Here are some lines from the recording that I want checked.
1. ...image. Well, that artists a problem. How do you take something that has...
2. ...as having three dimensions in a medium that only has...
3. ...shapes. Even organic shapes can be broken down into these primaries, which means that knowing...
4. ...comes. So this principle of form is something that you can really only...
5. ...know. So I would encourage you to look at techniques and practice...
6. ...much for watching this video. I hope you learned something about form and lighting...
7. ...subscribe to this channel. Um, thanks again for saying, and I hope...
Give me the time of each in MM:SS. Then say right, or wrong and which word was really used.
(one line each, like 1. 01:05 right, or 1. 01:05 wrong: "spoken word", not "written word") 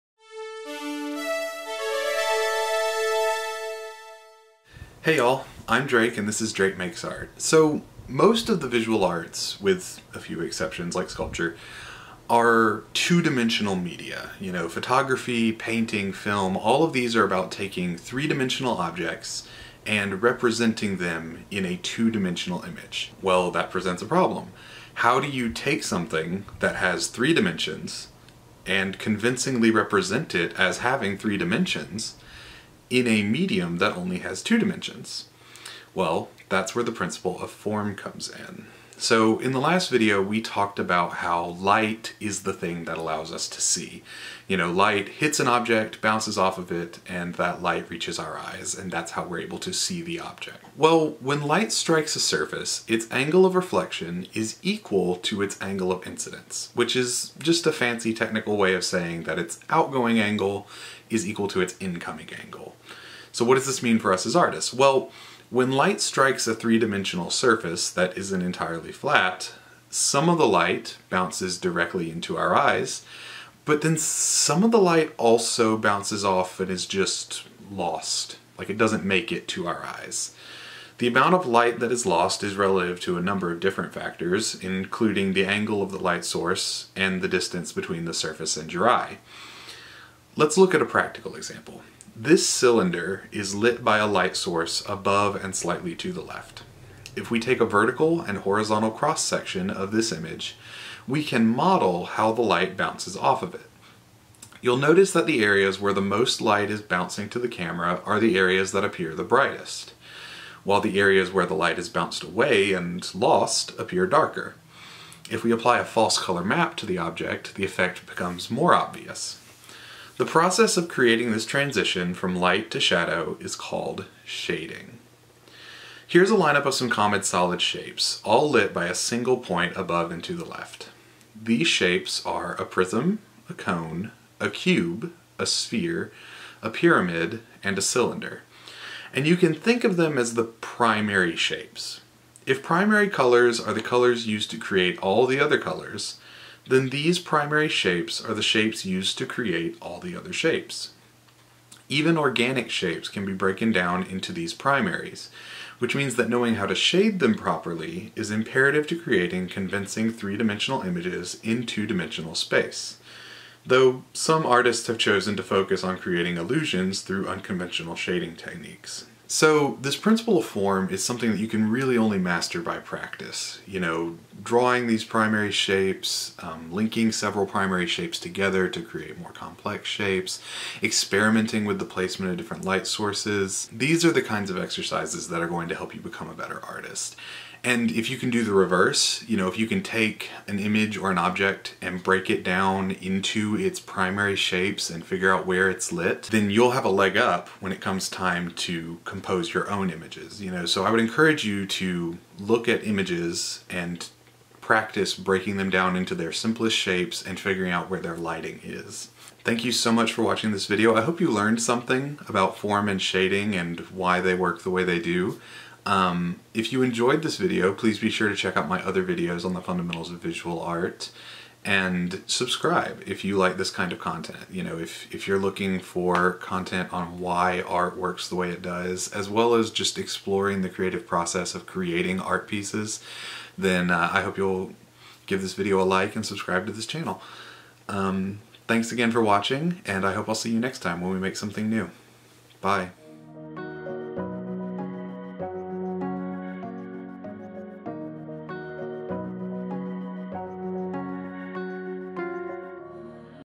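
1. 00:22 wrong: "presents", not "artists"
2. 00:30 right
3. 02:30 right
4. 02:48 wrong: "techniques", not "comes"
5. 03:20 wrong: "images", not "techniques"
6. 03:29 wrong: "shading", not "lighting"
7. 03:56 wrong: "watching", not "saying".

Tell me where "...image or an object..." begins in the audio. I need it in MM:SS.
03:10.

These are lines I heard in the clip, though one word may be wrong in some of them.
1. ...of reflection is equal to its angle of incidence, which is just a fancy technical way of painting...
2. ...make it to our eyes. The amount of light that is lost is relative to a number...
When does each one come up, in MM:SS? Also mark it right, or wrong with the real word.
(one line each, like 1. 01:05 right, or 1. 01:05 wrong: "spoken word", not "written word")
1. 00:53 wrong: "saying", not "painting"
2. 01:19 right.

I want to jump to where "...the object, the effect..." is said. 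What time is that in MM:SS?
01:56.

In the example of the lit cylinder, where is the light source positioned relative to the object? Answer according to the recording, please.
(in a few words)
Above and slightly to the left.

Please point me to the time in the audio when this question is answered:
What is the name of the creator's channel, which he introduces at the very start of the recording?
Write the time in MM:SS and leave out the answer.
00:06.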